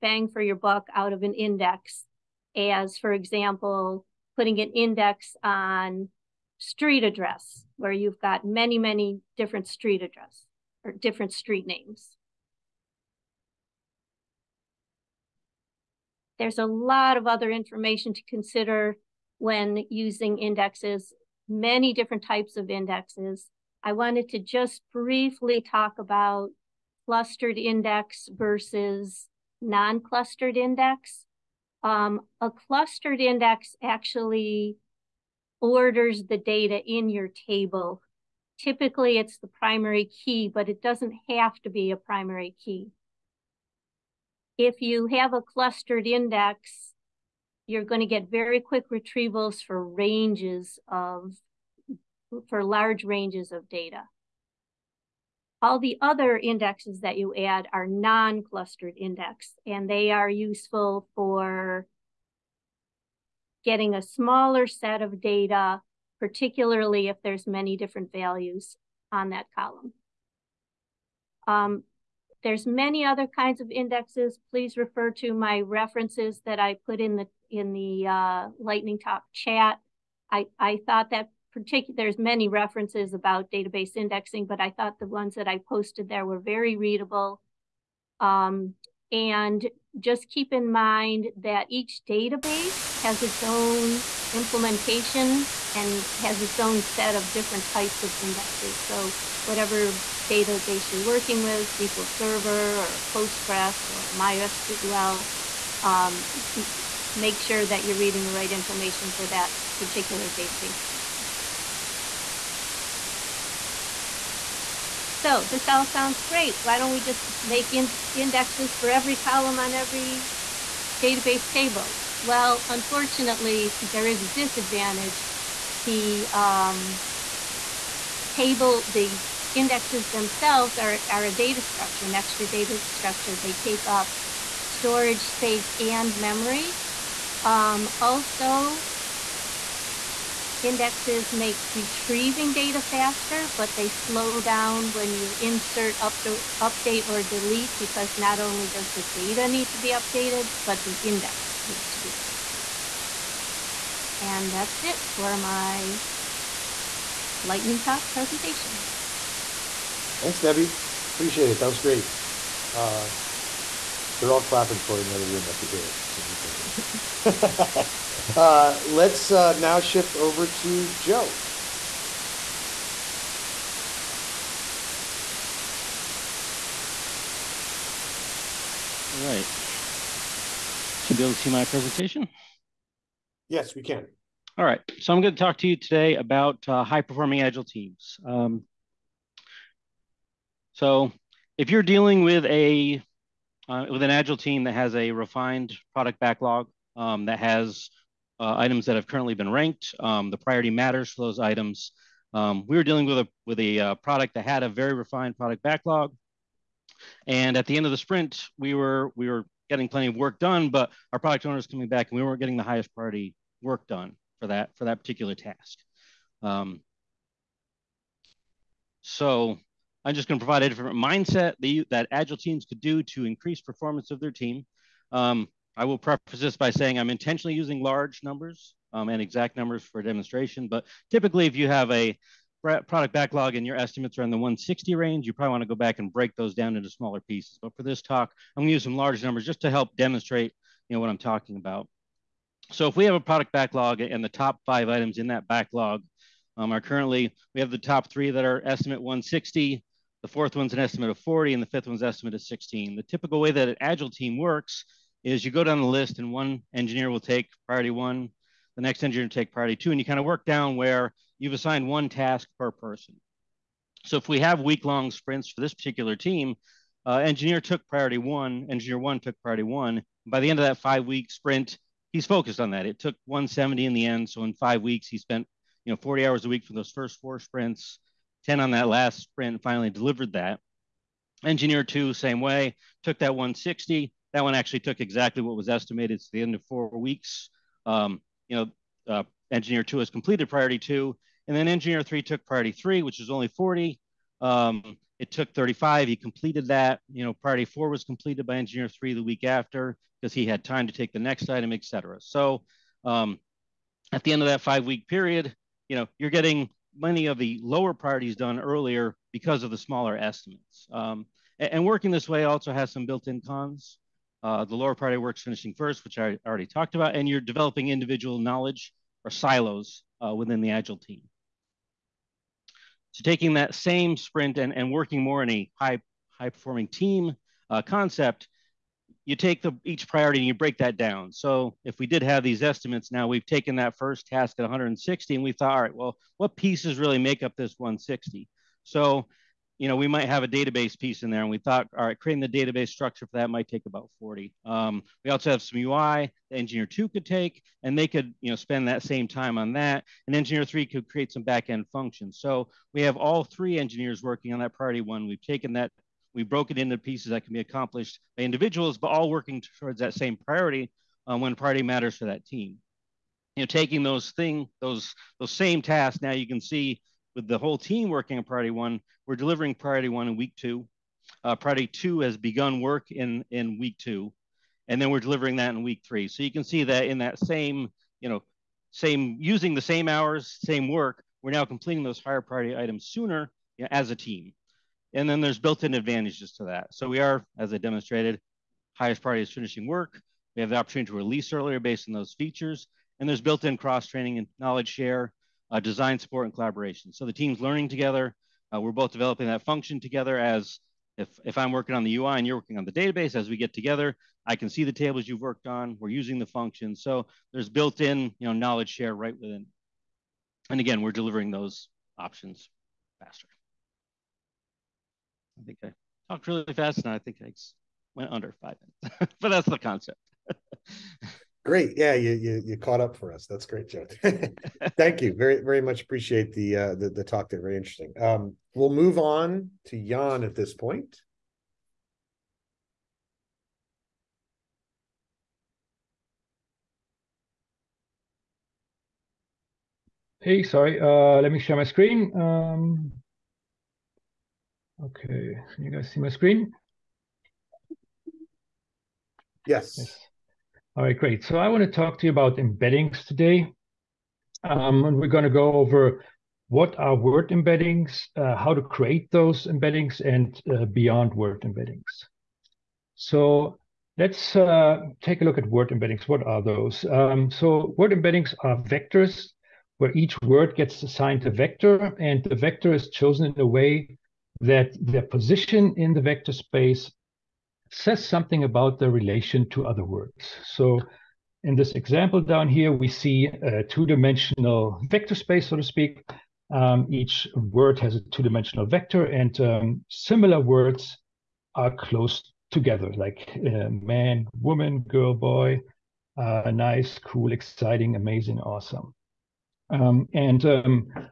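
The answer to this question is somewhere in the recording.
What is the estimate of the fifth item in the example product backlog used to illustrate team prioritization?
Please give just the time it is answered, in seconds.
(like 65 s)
252 s.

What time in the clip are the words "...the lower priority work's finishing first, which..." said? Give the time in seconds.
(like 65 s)
314 s.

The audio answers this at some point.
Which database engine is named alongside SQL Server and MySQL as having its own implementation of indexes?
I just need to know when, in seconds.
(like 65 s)
103 s.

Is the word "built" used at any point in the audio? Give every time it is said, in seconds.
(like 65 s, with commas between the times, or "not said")
313 s, 385 s, 393 s, 407 s.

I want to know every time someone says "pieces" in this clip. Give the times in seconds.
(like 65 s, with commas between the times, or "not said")
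237 s, 336 s, 340 s, 356 s.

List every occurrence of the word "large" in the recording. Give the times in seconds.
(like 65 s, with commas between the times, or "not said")
52 s, 227 s, 238 s.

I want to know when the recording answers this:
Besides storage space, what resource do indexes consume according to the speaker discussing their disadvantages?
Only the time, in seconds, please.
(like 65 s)
136 s.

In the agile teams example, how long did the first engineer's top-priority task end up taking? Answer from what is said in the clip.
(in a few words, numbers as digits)
170.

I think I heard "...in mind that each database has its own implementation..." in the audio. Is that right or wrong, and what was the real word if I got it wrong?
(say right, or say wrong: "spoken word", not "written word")
right.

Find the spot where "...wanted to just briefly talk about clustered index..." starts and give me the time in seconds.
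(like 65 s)
23 s.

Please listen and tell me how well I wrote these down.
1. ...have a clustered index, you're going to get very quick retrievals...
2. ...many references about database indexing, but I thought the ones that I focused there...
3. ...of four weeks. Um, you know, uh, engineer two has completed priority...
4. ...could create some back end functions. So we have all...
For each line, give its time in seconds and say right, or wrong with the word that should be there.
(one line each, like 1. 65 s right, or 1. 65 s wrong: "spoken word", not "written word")
1. 45 s right
2. 82 s wrong: "posted", not "focused"
3. 286 s right
4. 350 s right.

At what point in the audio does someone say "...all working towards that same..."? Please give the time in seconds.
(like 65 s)
359 s.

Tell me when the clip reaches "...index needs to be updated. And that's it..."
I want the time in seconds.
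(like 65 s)
150 s.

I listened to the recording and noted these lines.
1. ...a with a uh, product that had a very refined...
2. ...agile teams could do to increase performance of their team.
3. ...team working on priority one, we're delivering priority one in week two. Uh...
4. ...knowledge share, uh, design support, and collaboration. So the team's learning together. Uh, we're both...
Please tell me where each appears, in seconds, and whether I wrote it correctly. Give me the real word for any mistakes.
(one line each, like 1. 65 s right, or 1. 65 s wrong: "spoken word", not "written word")
1. 203 s right
2. 222 s right
3. 367 s right
4. 394 s right.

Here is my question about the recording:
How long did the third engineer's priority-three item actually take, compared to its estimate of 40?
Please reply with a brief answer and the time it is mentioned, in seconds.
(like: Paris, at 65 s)
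35, at 295 s.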